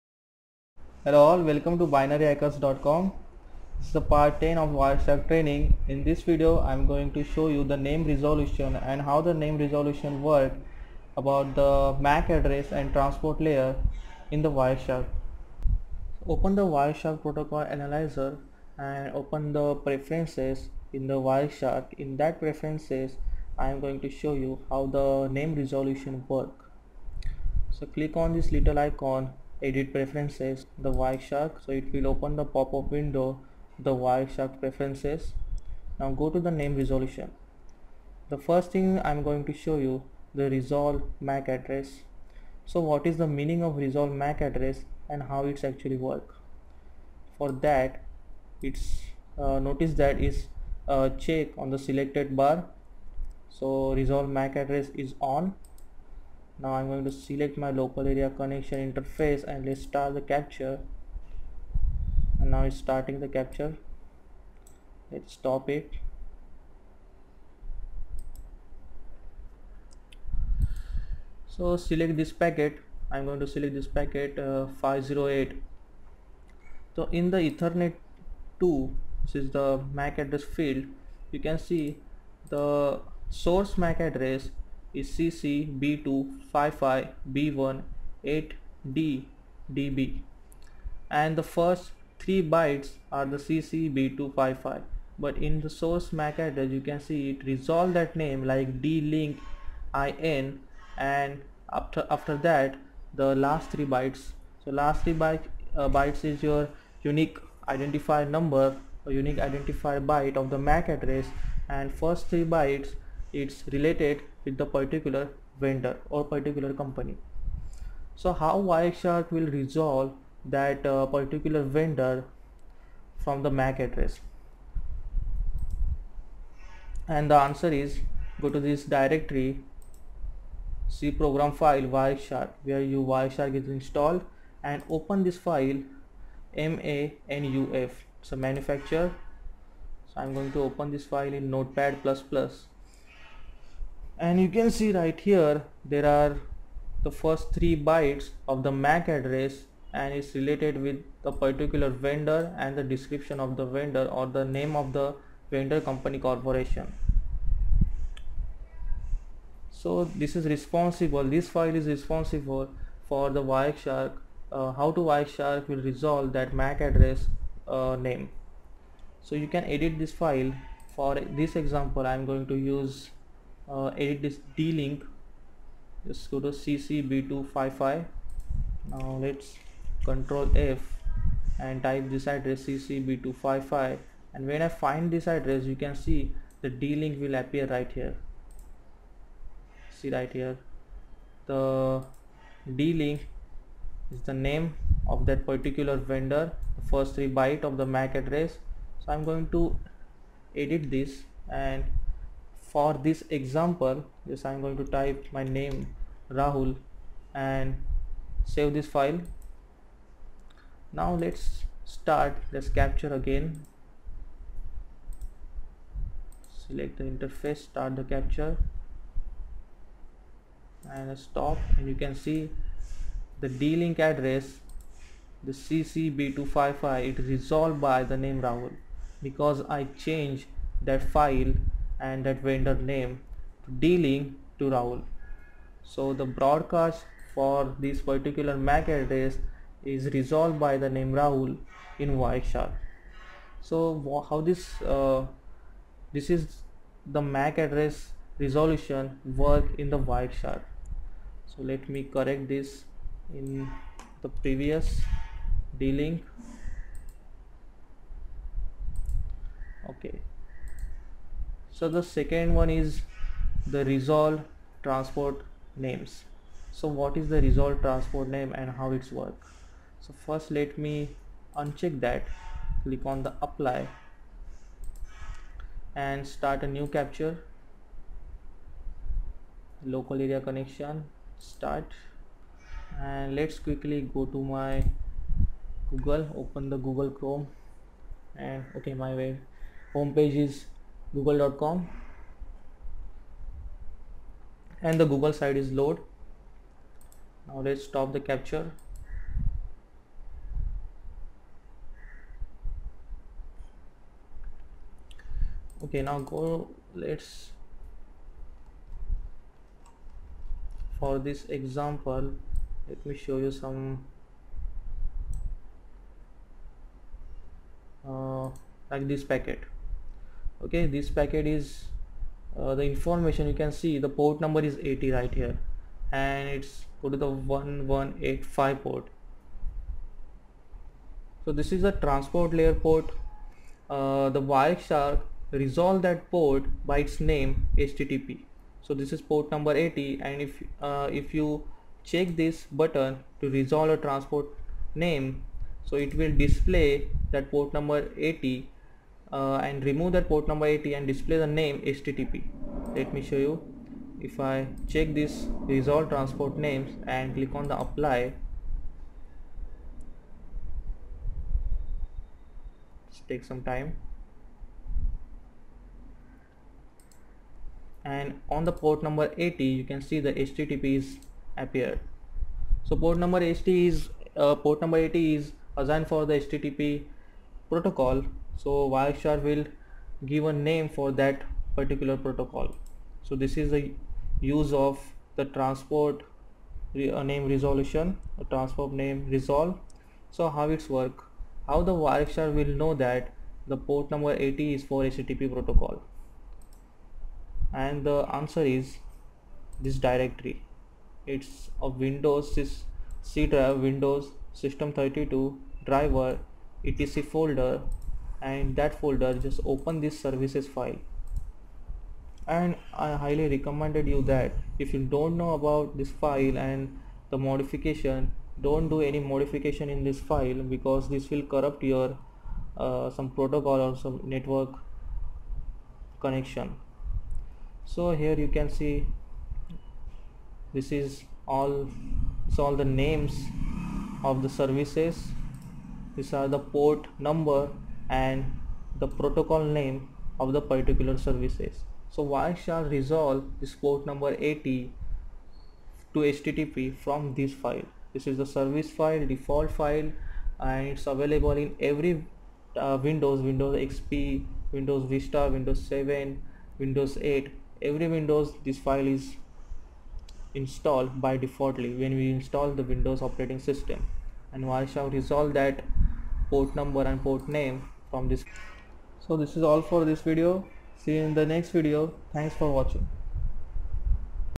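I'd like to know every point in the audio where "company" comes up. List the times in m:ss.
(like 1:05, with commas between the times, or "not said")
1:56, 2:35.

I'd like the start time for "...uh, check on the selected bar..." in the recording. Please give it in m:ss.
0:50.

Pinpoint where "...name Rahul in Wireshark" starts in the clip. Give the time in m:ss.
4:00.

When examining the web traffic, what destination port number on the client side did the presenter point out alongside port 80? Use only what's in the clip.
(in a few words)
1185.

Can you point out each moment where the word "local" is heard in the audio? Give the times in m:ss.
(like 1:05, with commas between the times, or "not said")
0:57, 4:39.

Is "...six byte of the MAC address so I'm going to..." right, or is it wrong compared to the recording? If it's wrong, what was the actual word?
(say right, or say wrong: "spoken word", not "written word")
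wrong: "three", not "six".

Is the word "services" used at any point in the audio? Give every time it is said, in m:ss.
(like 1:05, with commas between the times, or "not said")
6:50, 7:14, 7:21, 7:28.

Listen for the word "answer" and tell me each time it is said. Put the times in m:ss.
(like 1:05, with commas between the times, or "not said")
2:07, 6:38.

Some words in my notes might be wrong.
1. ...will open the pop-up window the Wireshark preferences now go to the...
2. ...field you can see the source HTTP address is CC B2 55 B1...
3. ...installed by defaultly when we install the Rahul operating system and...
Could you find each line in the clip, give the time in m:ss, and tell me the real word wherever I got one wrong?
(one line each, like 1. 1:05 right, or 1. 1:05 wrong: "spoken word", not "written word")
1. 0:31 right
2. 1:20 wrong: "MAC", not "HTTP"
3. 7:40 wrong: "Windows", not "Rahul".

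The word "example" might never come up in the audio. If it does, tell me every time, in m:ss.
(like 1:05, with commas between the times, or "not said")
2:51, 3:23, 5:11.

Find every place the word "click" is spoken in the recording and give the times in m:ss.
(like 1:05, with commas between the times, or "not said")
0:27, 4:32, 5:57.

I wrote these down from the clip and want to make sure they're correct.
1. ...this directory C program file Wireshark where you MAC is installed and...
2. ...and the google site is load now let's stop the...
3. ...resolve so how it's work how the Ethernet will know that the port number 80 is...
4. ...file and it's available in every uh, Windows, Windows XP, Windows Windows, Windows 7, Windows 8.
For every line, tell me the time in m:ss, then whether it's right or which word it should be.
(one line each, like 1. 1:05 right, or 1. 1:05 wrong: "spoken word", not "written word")
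1. 2:08 wrong: "Wireshark", not "MAC"
2. 4:54 right
3. 6:29 wrong: "Wireshark", not "Ethernet"
4. 7:29 wrong: "Vista", not "Windows".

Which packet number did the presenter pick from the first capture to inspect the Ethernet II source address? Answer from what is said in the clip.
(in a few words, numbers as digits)
508.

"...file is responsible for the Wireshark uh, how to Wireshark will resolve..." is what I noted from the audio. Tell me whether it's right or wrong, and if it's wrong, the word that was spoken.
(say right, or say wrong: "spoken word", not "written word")
right.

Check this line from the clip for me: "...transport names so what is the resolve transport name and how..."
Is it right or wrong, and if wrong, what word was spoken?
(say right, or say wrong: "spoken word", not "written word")
right.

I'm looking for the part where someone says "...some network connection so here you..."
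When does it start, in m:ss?
7:03.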